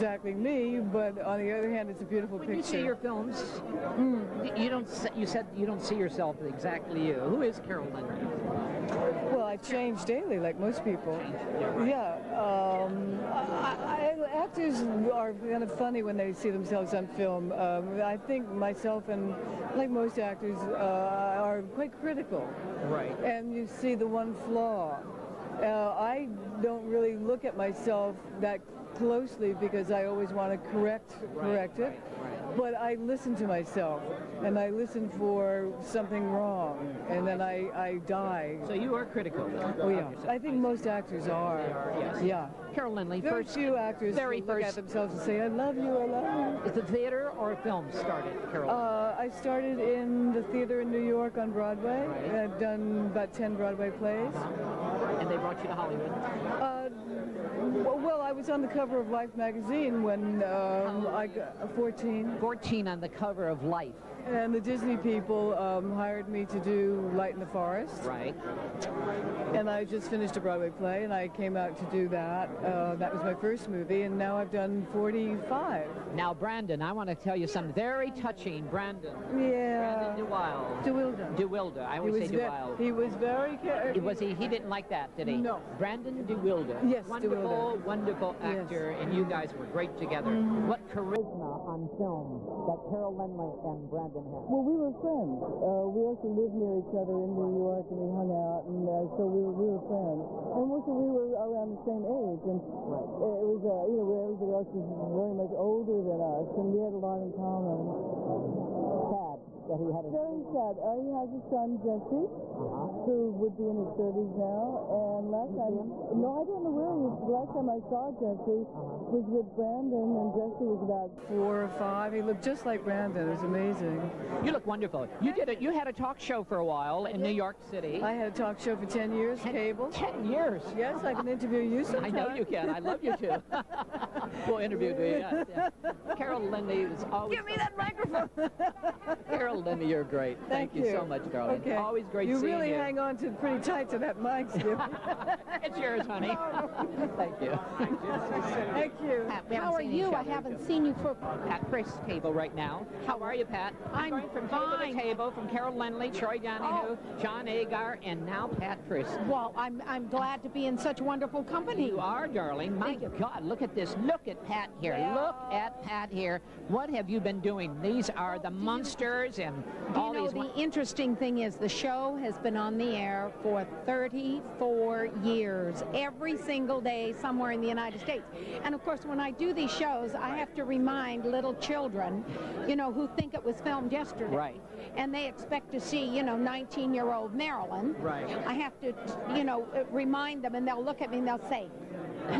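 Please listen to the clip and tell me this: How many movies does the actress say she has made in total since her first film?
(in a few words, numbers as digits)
45.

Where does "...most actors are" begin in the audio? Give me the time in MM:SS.
00:40.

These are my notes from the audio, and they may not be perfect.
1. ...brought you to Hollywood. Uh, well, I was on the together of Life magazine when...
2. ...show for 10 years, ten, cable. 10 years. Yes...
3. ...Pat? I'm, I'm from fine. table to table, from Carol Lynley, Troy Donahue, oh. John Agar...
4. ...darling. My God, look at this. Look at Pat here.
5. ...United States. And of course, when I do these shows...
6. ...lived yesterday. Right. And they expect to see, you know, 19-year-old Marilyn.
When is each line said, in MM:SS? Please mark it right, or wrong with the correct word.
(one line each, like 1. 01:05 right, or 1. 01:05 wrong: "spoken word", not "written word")
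1. 00:55 wrong: "cover", not "together"
2. 02:08 right
3. 02:33 right
4. 02:42 right
5. 02:57 right
6. 03:03 wrong: "filmed", not "lived".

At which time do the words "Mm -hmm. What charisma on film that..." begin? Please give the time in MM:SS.
01:30.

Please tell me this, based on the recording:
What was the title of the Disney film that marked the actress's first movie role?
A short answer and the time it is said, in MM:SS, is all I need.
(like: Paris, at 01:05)
Light in the Forest, at 01:07.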